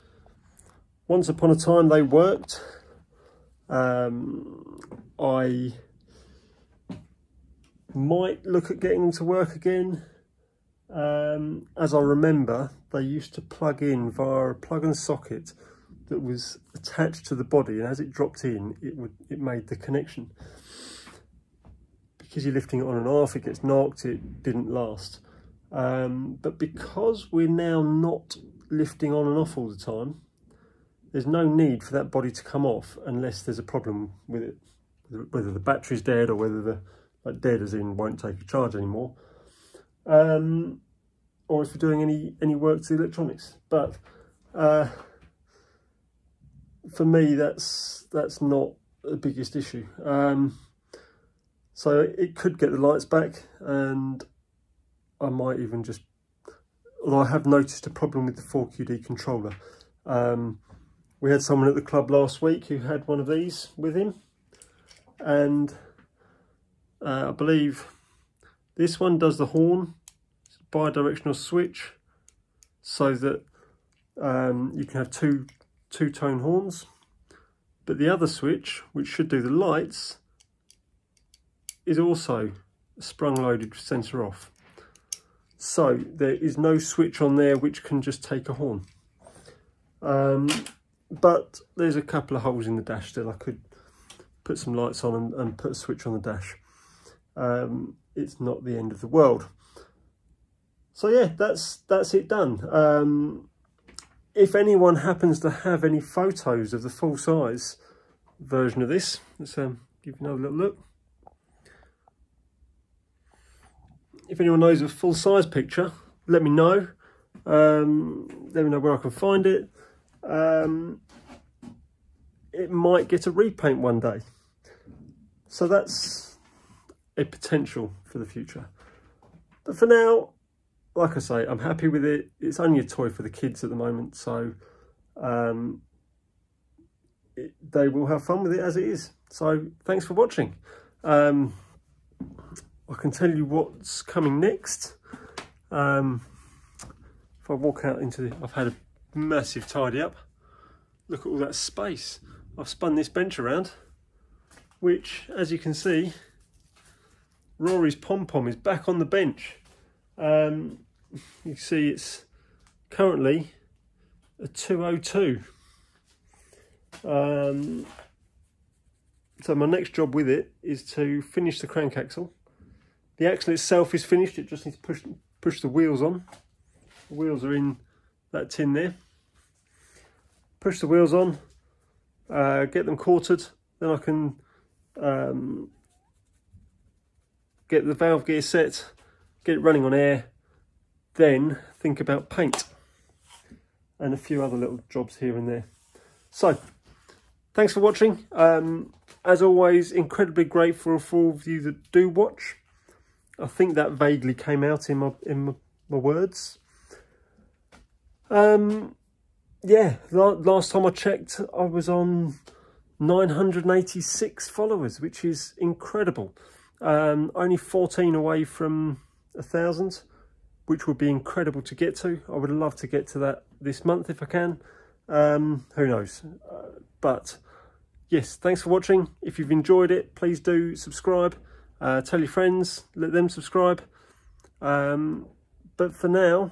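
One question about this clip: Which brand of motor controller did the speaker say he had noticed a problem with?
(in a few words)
4QD.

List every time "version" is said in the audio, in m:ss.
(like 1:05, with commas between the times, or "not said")
1:48.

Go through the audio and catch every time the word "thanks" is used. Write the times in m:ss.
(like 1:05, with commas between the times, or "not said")
2:19, 3:17, 3:48.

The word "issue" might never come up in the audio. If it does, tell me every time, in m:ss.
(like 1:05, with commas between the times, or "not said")
0:49.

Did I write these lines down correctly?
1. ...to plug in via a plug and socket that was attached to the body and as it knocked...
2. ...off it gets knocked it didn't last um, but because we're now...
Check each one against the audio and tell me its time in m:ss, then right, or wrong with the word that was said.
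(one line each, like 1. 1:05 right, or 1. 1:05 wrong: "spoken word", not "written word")
1. 0:13 wrong: "dropped", not "knocked"
2. 0:23 right.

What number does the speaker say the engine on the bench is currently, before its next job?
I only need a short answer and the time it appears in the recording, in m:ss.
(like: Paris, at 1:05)
202, at 2:44.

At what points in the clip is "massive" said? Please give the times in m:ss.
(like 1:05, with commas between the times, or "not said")
2:29.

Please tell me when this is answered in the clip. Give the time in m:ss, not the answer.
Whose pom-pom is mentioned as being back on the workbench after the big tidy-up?
2:37.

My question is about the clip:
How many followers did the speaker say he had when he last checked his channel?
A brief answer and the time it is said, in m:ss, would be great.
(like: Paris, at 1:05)
986, at 3:32.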